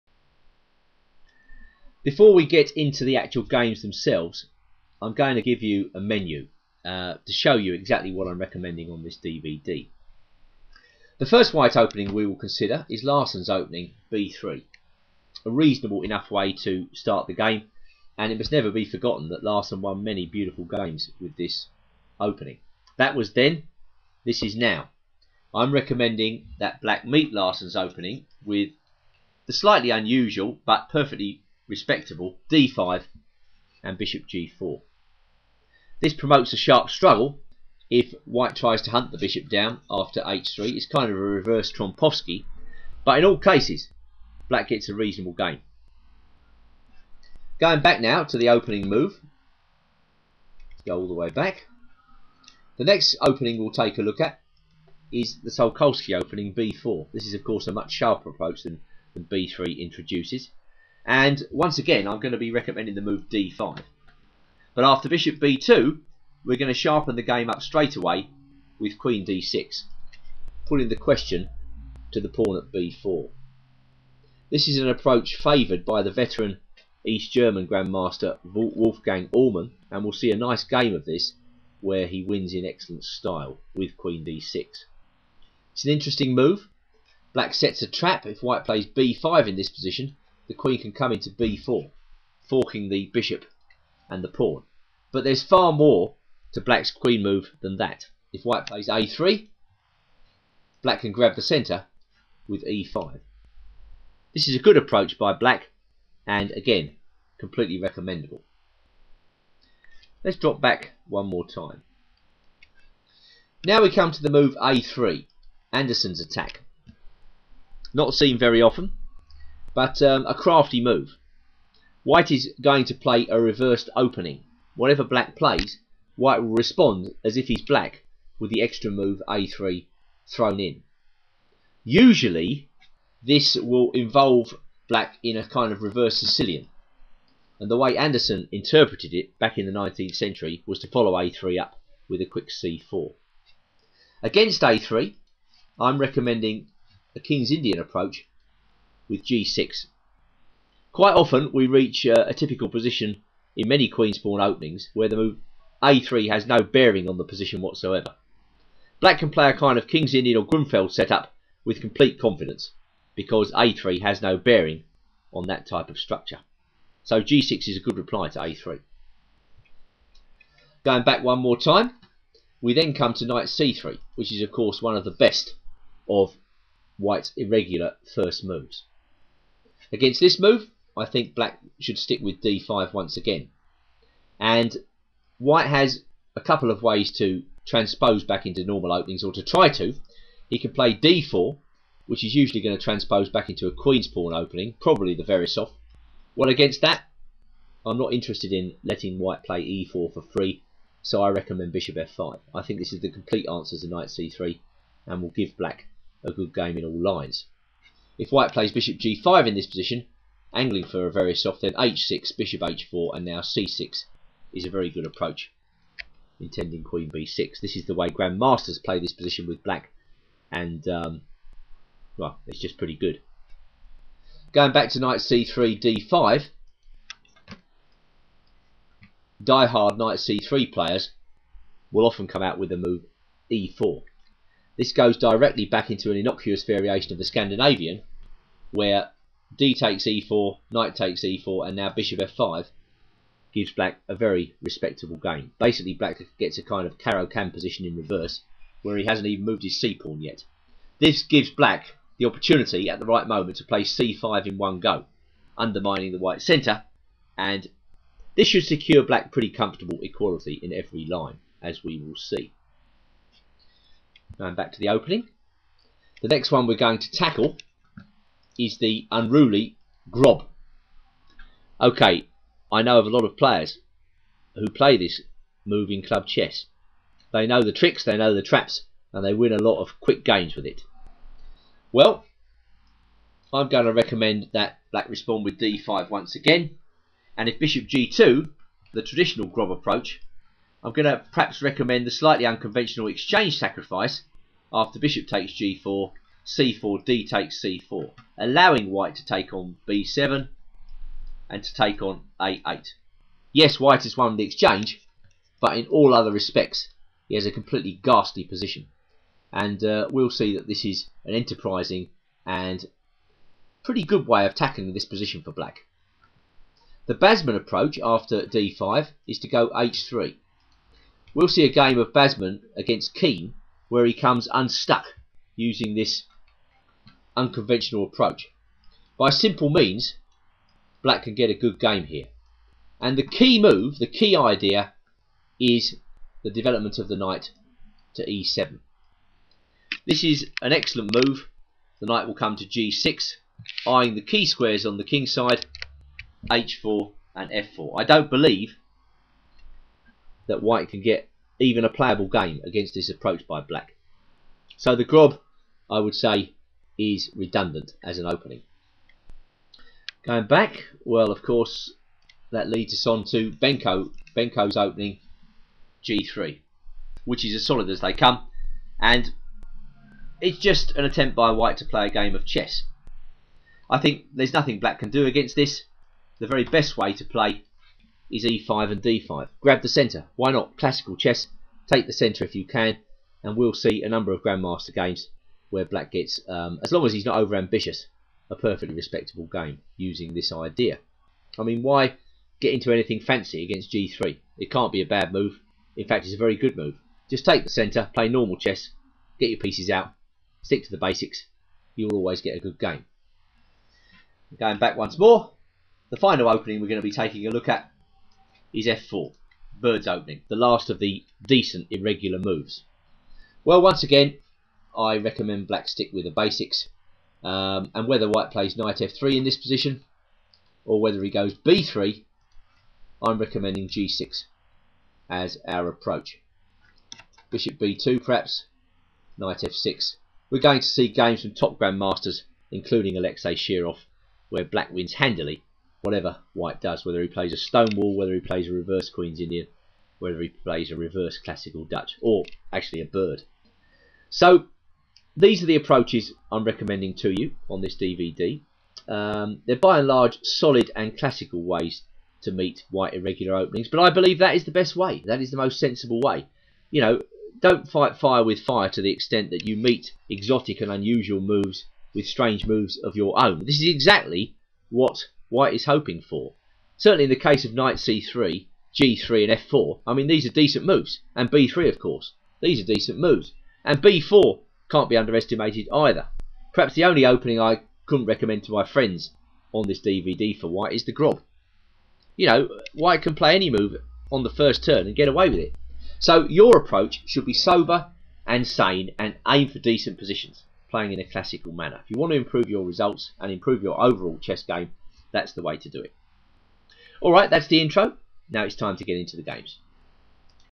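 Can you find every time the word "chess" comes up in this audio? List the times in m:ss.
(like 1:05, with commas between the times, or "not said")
4:36, 6:12, 6:21, 6:38, 8:14.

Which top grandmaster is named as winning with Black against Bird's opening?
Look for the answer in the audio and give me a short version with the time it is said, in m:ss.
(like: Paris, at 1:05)
Alexei Shirov, at 7:13.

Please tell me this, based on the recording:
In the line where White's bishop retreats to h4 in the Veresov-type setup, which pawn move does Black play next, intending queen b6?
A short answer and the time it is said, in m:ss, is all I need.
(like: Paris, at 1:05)
c6, at 3:33.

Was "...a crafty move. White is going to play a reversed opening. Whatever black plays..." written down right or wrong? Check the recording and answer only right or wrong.
right.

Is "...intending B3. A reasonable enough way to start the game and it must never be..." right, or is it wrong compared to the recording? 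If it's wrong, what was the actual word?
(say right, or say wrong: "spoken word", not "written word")
wrong: "opening", not "intending".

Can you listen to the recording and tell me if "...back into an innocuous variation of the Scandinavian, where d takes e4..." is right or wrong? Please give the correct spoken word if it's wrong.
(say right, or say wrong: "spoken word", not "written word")
right.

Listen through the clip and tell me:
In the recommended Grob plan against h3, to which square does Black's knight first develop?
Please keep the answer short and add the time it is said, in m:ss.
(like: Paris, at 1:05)
e7, at 5:38.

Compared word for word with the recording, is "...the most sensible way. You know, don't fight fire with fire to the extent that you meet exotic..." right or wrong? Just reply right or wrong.
right.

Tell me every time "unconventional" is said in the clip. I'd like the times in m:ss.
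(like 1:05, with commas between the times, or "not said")
4:52, 5:27.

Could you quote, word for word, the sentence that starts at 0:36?
This promotes a sharp struggle if white tries to hunt the bishop down after h3.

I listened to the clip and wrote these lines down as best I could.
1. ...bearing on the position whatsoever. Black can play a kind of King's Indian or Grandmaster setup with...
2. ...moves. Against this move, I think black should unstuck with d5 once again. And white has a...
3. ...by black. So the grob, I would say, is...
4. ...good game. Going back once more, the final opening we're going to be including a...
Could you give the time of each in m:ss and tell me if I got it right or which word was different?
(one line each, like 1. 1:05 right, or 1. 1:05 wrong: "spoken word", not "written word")
1. 2:36 wrong: "Grunfeld", not "Grandmaster"
2. 2:58 wrong: "stick", not "unstuck"
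3. 5:53 right
4. 6:42 wrong: "taking", not "including".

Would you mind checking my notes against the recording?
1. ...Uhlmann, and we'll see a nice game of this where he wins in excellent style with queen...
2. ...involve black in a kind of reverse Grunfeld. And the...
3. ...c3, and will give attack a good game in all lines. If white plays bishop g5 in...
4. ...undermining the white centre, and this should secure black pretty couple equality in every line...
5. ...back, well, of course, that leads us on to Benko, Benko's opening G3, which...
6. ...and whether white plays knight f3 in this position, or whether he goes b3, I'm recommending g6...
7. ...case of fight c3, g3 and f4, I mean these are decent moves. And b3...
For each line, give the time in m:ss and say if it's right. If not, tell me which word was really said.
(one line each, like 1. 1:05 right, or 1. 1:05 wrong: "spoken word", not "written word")
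1. 1:19 right
2. 2:13 wrong: "Sicilian", not "Grunfeld"
3. 3:24 wrong: "black", not "attack"
4. 4:15 wrong: "comfortable", not "couple"
5. 6:00 right
6. 6:57 right
7. 7:47 wrong: "knight", not "fight".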